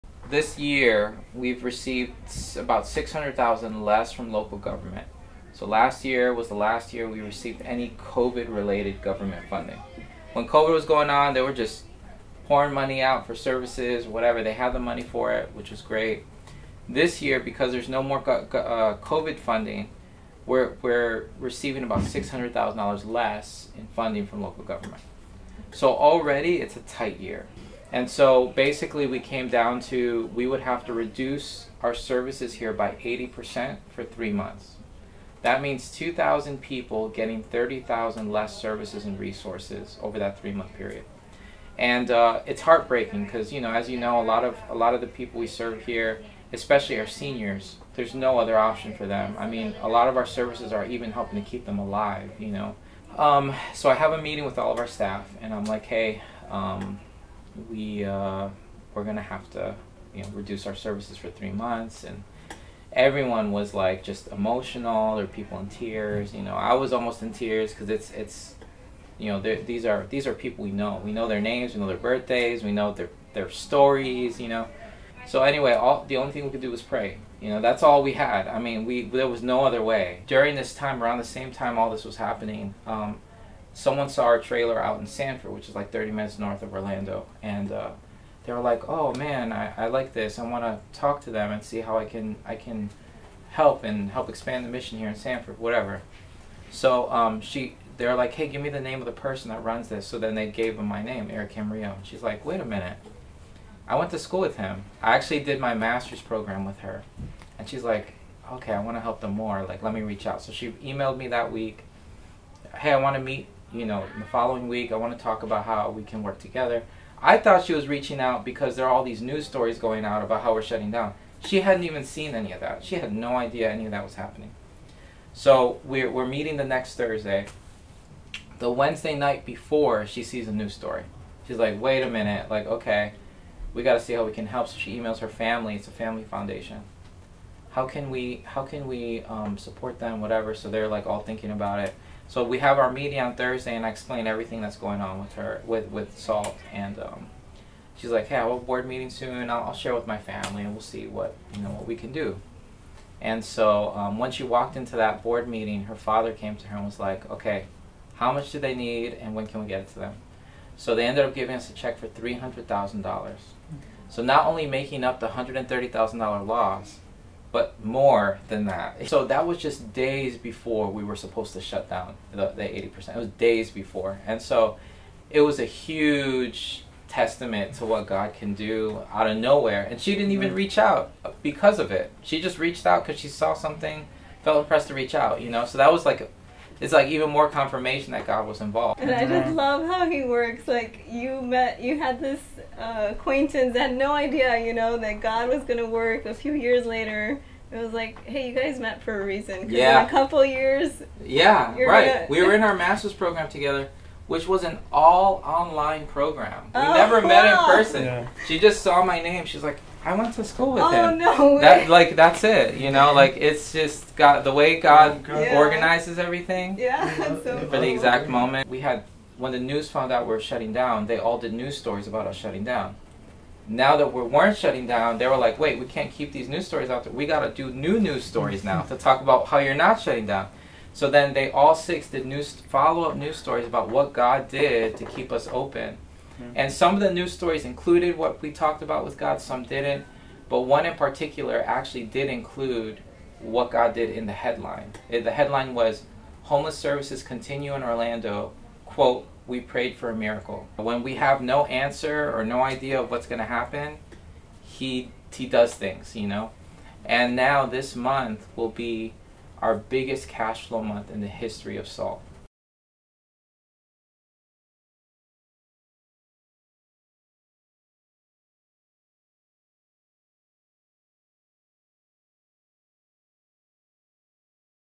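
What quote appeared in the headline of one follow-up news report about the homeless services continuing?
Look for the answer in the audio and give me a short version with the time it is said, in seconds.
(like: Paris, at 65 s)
We prayed for a miracle, at 249 s.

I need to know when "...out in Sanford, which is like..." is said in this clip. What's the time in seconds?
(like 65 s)
84 s.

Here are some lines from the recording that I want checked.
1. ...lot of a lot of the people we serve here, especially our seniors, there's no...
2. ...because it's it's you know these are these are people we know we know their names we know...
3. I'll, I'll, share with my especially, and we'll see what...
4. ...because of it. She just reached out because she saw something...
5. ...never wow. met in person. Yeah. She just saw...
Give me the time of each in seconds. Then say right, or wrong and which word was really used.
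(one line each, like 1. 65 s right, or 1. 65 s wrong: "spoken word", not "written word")
1. 44 s right
2. 67 s right
3. 149 s wrong: "family", not "especially"
4. 181 s right
5. 206 s right.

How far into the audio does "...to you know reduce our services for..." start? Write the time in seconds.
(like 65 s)
59 s.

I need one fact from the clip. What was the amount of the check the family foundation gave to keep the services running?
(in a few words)
$300,000.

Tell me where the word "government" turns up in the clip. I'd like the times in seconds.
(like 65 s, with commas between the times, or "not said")
4 s, 9 s, 24 s.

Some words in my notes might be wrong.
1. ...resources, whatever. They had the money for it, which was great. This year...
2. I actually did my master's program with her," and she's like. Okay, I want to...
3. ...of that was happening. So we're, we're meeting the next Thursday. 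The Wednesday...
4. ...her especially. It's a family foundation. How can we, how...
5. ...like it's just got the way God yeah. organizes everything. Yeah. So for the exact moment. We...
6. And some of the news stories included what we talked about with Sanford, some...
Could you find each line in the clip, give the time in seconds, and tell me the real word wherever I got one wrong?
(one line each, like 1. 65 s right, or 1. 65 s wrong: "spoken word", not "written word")
1. 13 s wrong: "services", not "resources"
2. 105 s right
3. 123 s right
4. 135 s wrong: "family", not "especially"
5. 213 s right
6. 236 s wrong: "God", not "Sanford".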